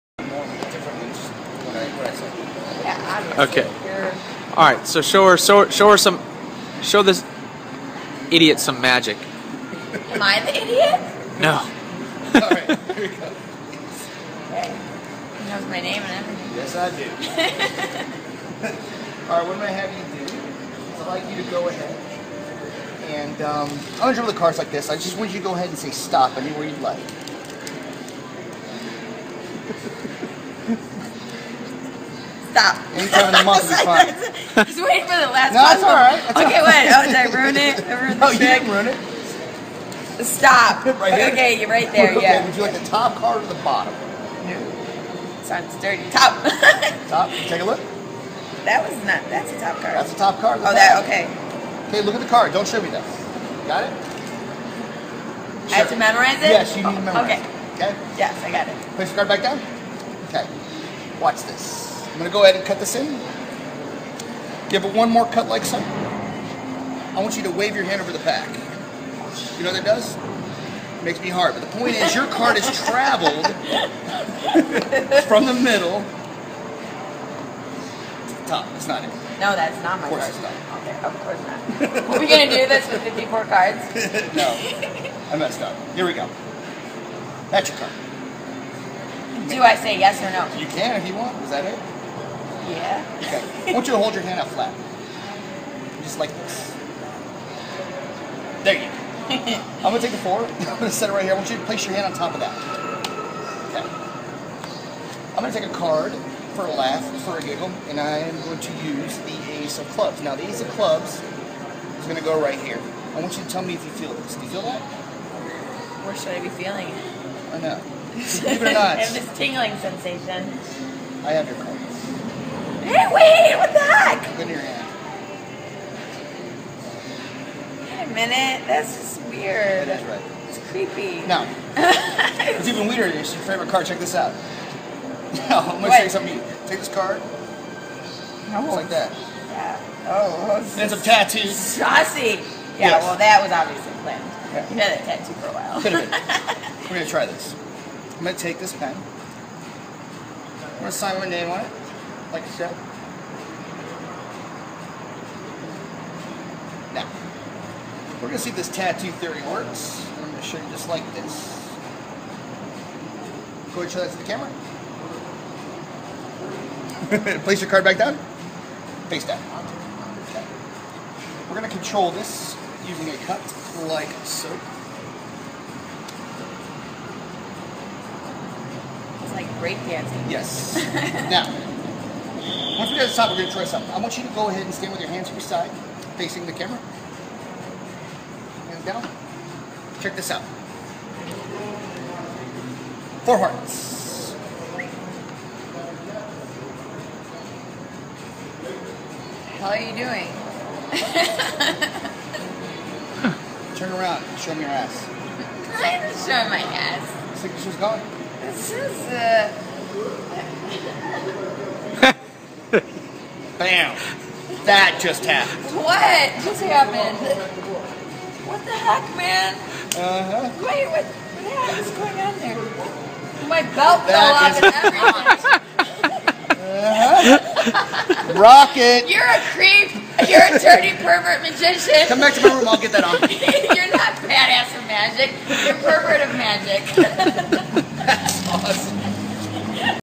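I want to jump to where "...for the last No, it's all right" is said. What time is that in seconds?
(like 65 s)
35 s.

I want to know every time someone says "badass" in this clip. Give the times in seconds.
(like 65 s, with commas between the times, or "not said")
234 s.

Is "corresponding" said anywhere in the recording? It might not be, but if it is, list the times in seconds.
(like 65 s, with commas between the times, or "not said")
not said.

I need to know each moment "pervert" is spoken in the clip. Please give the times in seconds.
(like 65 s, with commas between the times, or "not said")
231 s, 235 s.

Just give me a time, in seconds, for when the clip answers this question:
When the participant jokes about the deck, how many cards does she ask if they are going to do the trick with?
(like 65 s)
83 s.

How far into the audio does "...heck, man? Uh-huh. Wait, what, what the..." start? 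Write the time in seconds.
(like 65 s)
218 s.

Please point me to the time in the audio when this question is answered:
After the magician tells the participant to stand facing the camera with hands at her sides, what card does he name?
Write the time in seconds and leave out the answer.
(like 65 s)
193 s.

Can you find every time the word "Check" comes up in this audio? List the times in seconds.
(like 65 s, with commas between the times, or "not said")
133 s, 190 s.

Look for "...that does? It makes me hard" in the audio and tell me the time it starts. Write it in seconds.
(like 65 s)
69 s.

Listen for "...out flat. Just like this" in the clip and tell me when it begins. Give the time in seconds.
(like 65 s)
94 s.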